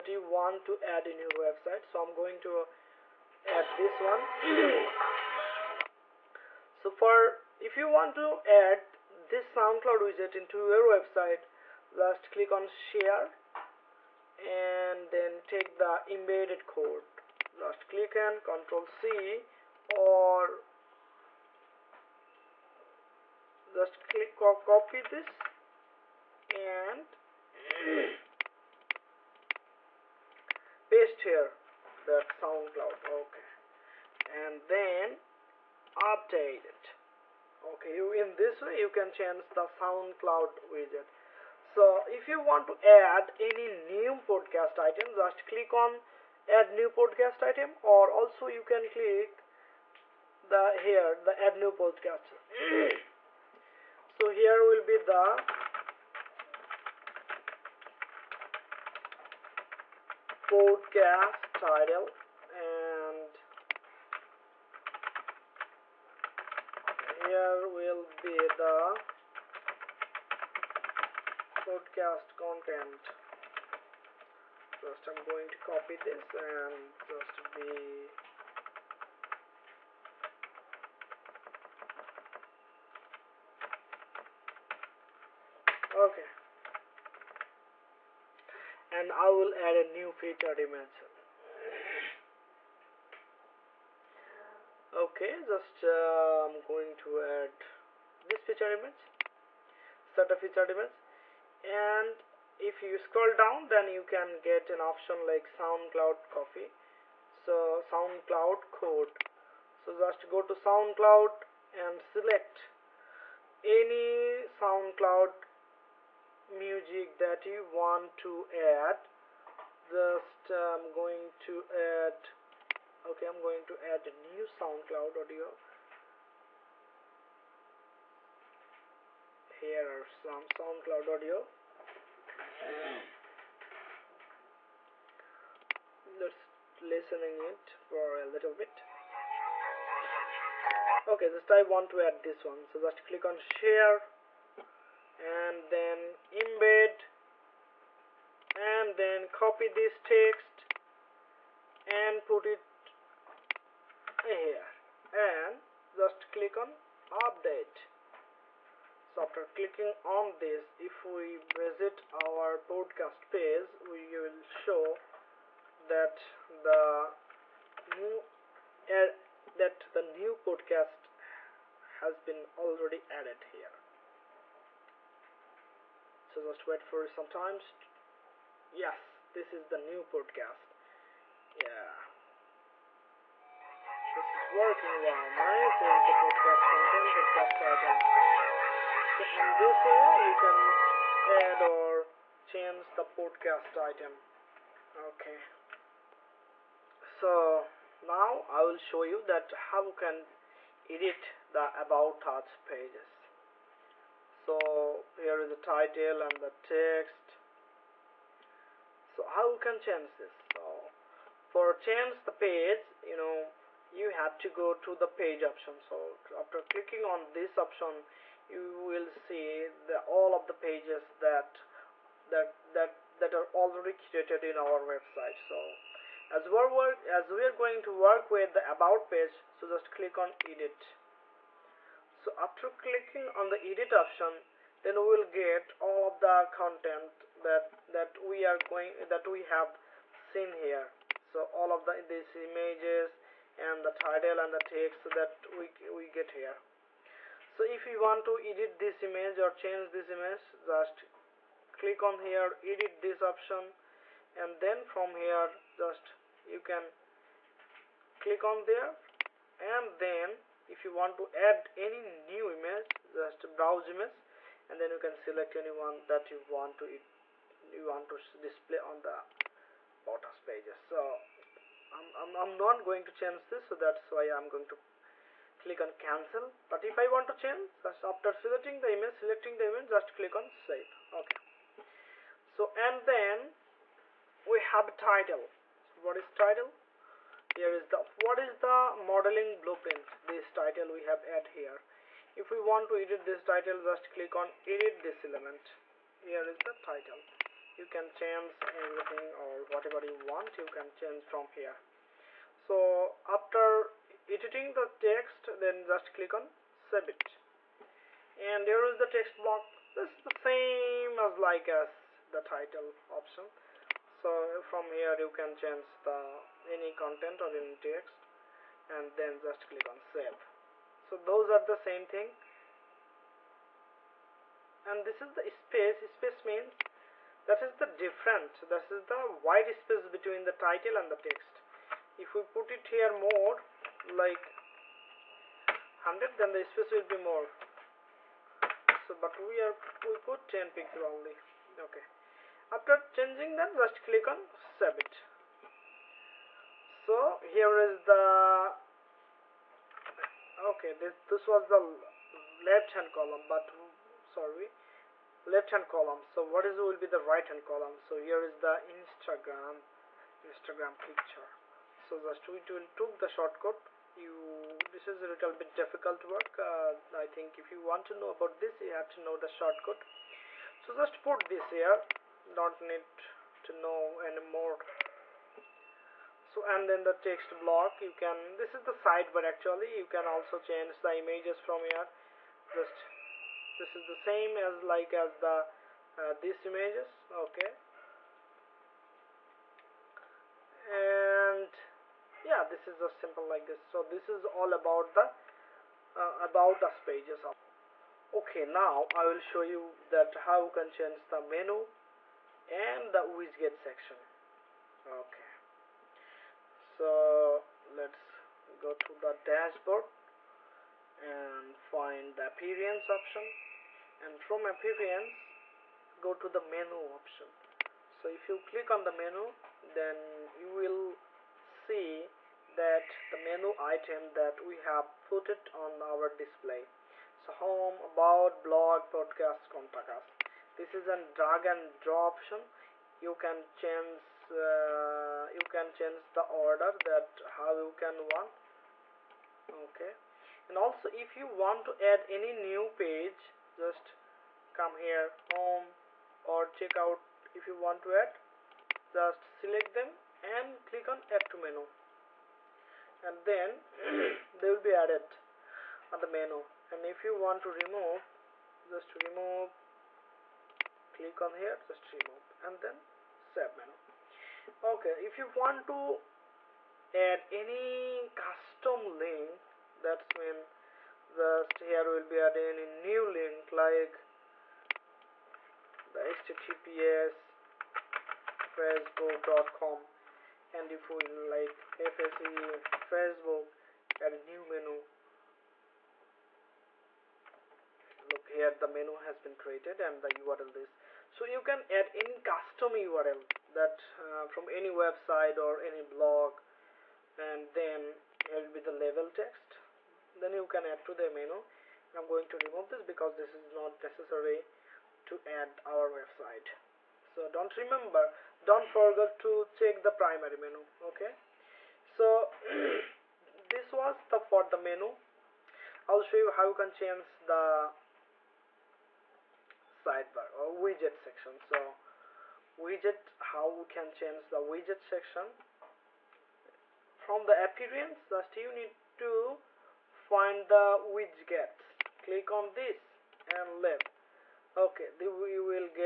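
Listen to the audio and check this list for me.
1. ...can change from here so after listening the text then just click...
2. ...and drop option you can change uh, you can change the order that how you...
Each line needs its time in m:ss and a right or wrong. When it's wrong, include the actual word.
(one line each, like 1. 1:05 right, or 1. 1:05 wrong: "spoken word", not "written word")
1. 5:00 wrong: "editing", not "listening"
2. 7:11 right.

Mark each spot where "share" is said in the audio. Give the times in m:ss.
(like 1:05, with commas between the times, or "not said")
0:12, 2:23.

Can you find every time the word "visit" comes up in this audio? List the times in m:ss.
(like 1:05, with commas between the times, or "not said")
2:41.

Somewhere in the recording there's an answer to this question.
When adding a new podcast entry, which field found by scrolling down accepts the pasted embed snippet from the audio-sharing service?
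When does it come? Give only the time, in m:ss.
1:47.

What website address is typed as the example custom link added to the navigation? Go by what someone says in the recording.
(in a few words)
https facebook.com.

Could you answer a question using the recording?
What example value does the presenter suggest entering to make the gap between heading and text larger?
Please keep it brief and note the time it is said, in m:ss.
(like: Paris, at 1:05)
100, at 5:35.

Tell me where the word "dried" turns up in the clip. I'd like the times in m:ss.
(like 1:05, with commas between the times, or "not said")
not said.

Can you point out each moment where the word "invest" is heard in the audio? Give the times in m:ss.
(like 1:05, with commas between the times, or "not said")
not said.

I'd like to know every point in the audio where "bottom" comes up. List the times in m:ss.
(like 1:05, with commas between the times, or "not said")
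4:30.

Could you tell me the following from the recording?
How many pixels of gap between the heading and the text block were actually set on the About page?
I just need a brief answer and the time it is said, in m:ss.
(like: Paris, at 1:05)
10, at 5:40.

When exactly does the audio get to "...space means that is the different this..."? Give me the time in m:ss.
5:26.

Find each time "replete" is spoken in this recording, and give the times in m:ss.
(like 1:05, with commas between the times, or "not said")
not said.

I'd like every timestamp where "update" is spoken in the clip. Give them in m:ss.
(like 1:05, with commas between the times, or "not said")
0:36, 2:37.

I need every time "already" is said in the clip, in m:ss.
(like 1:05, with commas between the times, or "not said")
2:52, 3:43.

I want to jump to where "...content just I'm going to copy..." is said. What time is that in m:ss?
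1:12.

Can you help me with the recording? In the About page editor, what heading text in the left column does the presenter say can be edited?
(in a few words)
what is the modeling blueprint.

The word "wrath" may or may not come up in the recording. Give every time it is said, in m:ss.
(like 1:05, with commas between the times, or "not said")
not said.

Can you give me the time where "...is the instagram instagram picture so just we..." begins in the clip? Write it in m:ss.
5:58.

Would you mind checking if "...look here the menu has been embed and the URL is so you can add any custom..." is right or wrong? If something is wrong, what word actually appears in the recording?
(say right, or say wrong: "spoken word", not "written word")
wrong: "created", not "embed".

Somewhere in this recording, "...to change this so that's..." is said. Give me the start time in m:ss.
4:33.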